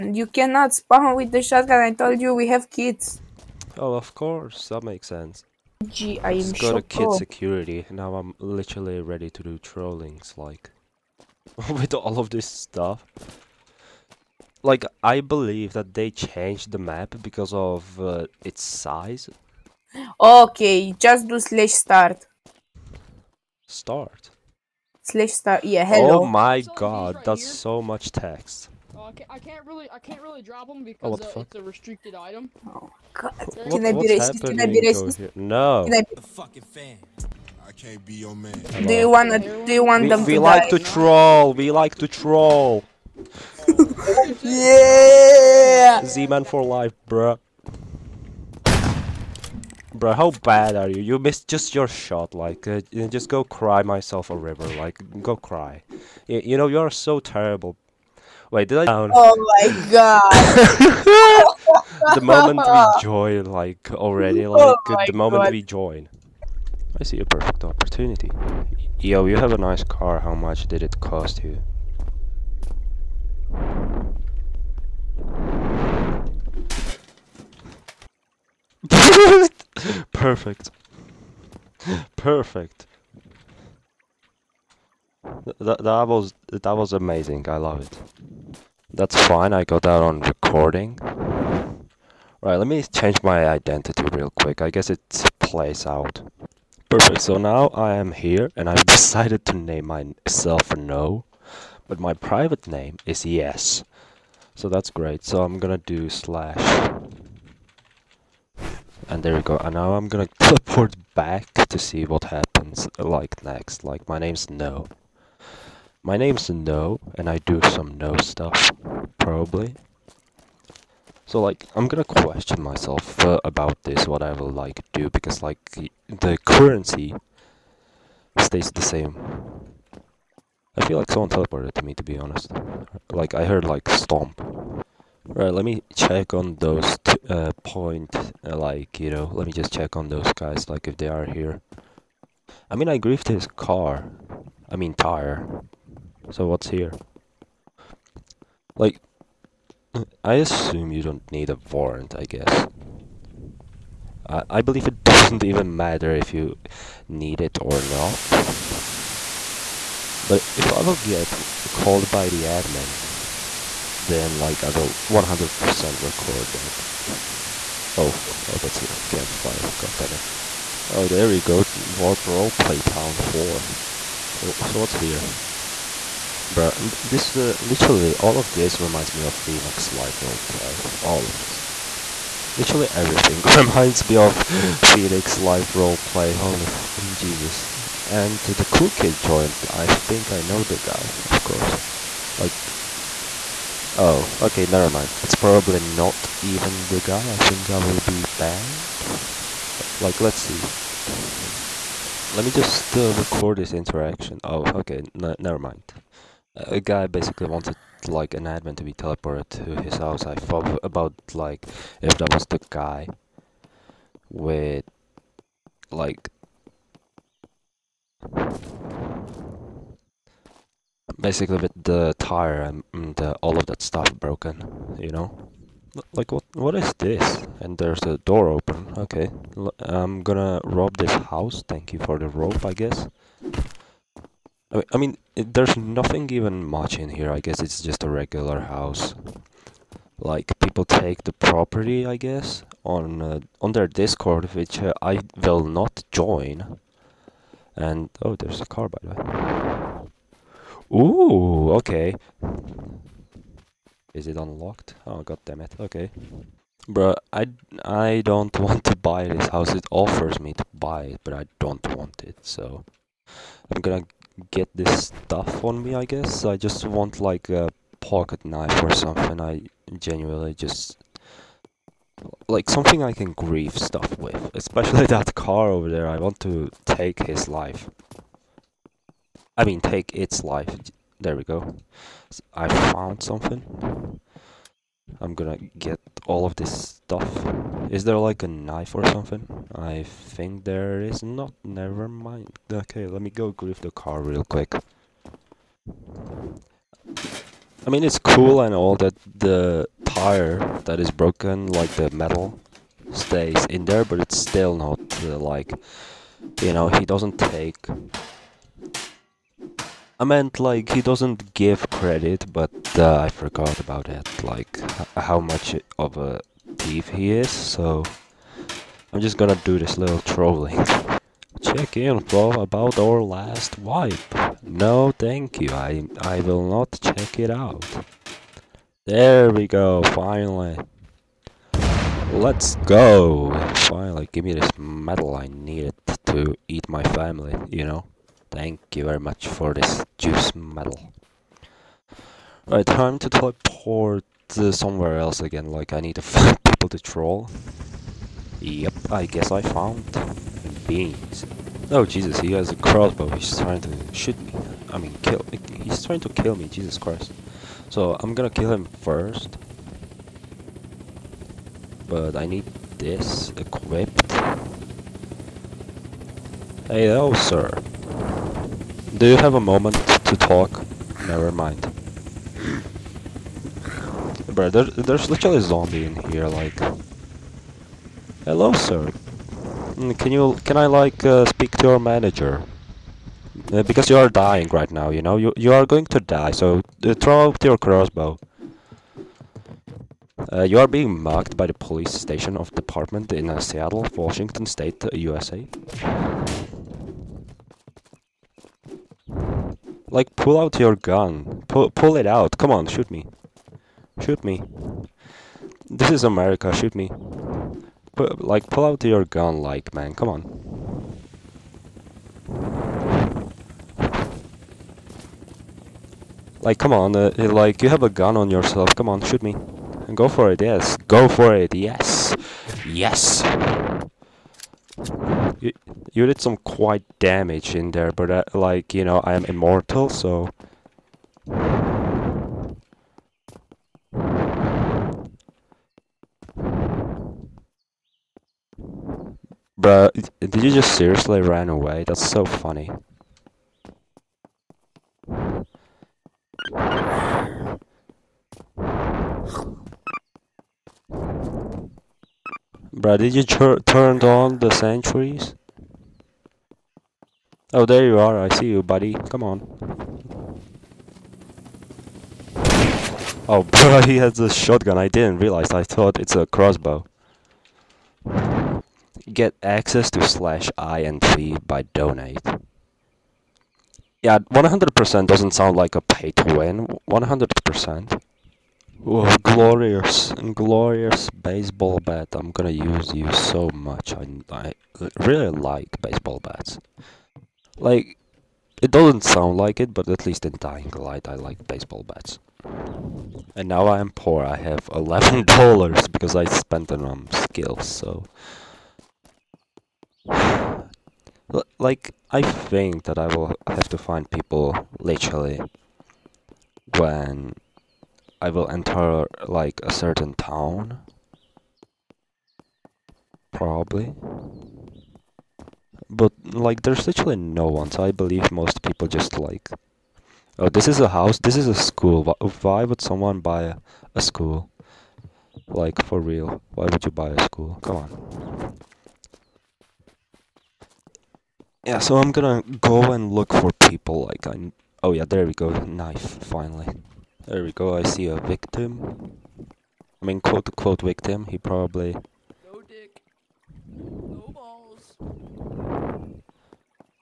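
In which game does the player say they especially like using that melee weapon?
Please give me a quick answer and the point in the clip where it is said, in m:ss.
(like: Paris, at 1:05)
Dying Light, at 8:10.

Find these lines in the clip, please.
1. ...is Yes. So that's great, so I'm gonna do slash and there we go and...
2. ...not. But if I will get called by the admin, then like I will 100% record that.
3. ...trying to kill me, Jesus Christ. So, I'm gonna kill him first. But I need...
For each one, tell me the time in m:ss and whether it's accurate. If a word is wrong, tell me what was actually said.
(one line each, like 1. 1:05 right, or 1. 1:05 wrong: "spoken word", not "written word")
1. 1:43 right
2. 2:37 right
3. 5:56 right.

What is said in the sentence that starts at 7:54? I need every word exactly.
Yeah, 100% doesn't sound like a pay to win.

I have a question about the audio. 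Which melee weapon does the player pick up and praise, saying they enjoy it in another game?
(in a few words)
Baseball bat.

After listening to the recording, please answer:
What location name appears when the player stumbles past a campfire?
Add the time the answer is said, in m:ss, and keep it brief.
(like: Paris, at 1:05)
Warp Roleplay Town 4, at 2:51.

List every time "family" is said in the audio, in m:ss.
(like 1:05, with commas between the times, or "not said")
5:37.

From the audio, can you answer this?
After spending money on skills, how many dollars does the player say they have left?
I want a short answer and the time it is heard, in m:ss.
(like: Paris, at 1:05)
$11, at 8:14.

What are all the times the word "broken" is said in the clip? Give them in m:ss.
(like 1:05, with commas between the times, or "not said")
3:44, 5:01.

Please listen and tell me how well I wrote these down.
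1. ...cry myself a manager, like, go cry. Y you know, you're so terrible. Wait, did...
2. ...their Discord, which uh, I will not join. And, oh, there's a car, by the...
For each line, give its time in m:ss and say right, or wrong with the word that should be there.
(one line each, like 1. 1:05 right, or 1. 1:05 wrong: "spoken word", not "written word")
1. 0:53 wrong: "river", not "manager"
2. 4:03 right.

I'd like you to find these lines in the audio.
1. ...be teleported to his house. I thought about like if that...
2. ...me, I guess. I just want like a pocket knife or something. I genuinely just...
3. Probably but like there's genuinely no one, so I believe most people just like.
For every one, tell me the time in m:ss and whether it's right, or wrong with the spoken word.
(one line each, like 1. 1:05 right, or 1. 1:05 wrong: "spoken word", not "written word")
1. 3:28 right
2. 4:25 right
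3. 8:33 wrong: "literally", not "genuinely".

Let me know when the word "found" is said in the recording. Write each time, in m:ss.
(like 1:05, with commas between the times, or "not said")
4:42, 5:49.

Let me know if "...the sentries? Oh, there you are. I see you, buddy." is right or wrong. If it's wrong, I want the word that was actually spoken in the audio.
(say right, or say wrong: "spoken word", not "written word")
right.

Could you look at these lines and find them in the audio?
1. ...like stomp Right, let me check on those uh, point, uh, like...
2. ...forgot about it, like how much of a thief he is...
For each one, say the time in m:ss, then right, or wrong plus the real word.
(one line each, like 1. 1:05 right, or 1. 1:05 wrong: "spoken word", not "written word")
1. 2:13 right
2. 5:13 right.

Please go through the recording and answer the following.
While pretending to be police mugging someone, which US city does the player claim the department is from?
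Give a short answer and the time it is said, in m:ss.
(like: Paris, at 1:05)
Seattle, at 6:33.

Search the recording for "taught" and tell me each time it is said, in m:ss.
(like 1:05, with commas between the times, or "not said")
not said.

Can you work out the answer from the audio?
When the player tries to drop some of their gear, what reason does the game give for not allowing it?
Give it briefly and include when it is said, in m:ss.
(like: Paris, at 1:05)
Restricted item, at 0:31.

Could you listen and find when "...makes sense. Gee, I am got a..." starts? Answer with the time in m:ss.
0:04.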